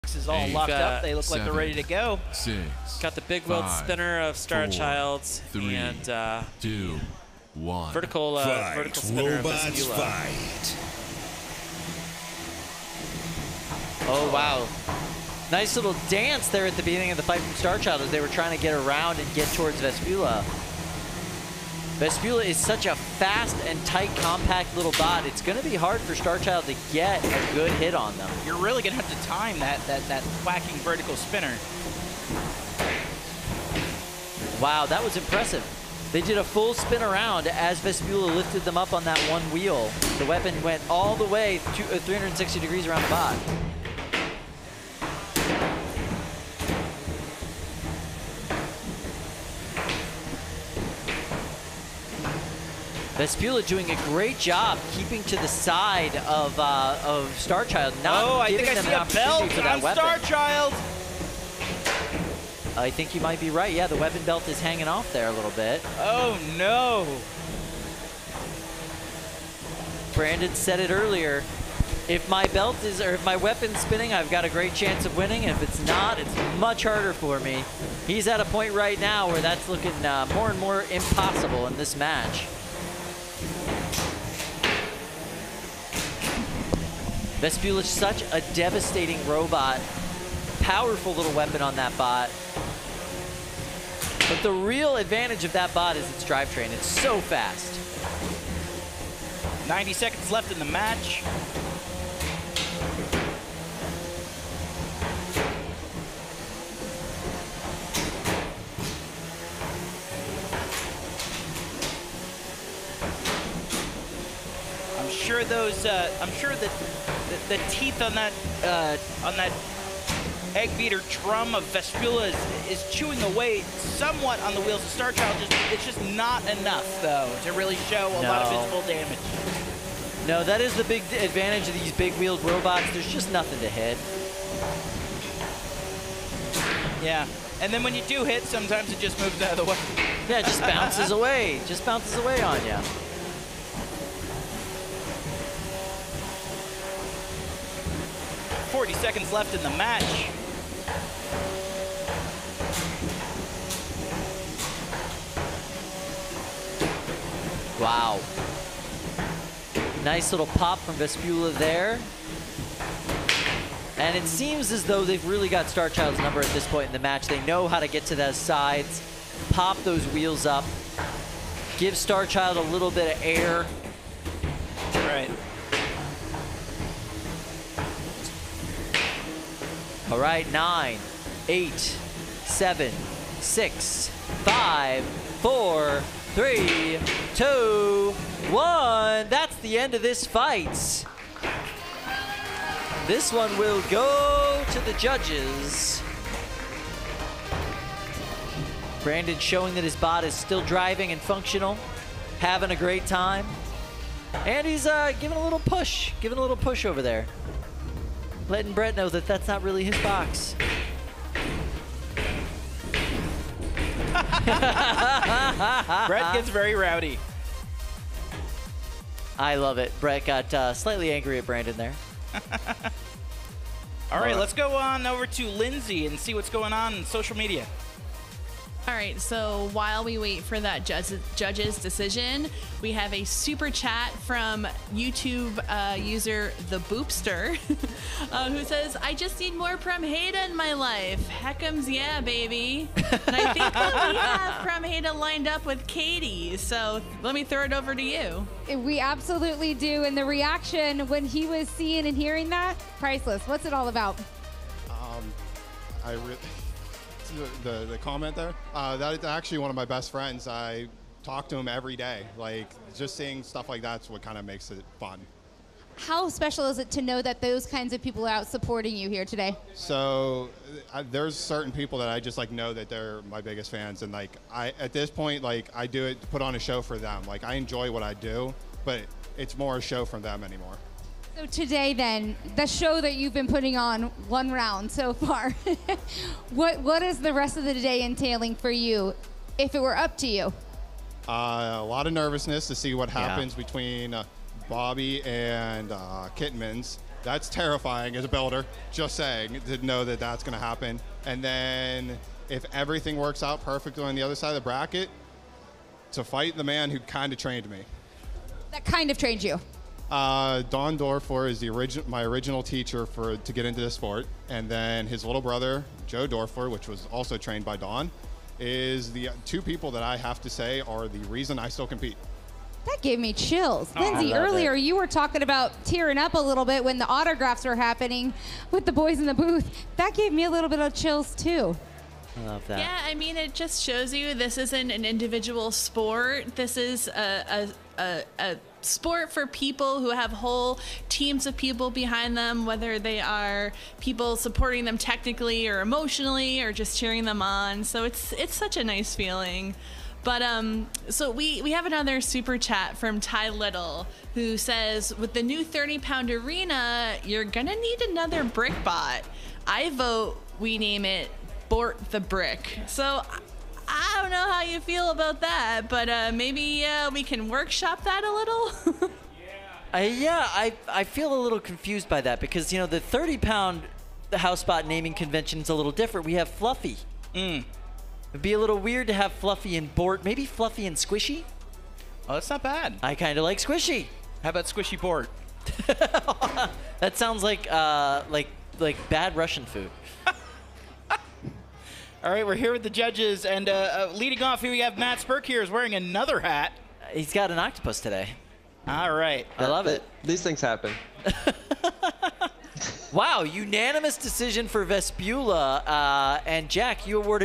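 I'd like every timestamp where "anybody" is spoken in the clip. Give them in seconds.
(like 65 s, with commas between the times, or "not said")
not said.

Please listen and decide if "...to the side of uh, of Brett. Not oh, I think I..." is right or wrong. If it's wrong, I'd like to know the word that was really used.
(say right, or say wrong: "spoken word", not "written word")
wrong: "Starchild", not "Brett".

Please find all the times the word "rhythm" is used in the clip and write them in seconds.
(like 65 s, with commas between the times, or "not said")
not said.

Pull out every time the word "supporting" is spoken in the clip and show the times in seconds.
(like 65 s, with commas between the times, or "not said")
268 s, 344 s.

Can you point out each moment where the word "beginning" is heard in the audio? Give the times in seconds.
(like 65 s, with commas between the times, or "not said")
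16 s.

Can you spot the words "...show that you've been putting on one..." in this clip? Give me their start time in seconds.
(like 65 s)
282 s.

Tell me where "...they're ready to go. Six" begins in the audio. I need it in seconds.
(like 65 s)
1 s.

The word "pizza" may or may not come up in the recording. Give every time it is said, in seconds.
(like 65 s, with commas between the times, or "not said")
not said.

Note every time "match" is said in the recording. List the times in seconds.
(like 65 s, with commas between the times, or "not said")
81 s, 100 s, 149 s, 166 s.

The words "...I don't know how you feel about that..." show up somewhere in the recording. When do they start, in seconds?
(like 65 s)
364 s.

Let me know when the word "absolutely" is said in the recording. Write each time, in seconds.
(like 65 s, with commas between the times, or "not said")
248 s.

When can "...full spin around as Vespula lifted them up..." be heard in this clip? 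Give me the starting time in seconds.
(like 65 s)
36 s.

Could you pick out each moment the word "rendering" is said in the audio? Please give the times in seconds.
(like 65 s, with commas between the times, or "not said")
not said.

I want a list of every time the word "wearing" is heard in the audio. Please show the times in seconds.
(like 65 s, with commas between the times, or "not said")
395 s.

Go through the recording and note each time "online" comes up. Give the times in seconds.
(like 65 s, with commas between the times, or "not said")
not said.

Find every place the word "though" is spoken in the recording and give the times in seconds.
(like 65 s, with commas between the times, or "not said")
127 s, 164 s.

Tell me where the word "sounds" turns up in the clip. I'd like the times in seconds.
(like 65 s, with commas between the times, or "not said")
387 s.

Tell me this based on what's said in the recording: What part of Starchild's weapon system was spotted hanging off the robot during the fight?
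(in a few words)
The weapon belt.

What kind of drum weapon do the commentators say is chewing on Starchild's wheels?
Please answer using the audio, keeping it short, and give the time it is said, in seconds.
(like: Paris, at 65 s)
Egg beater, at 120 s.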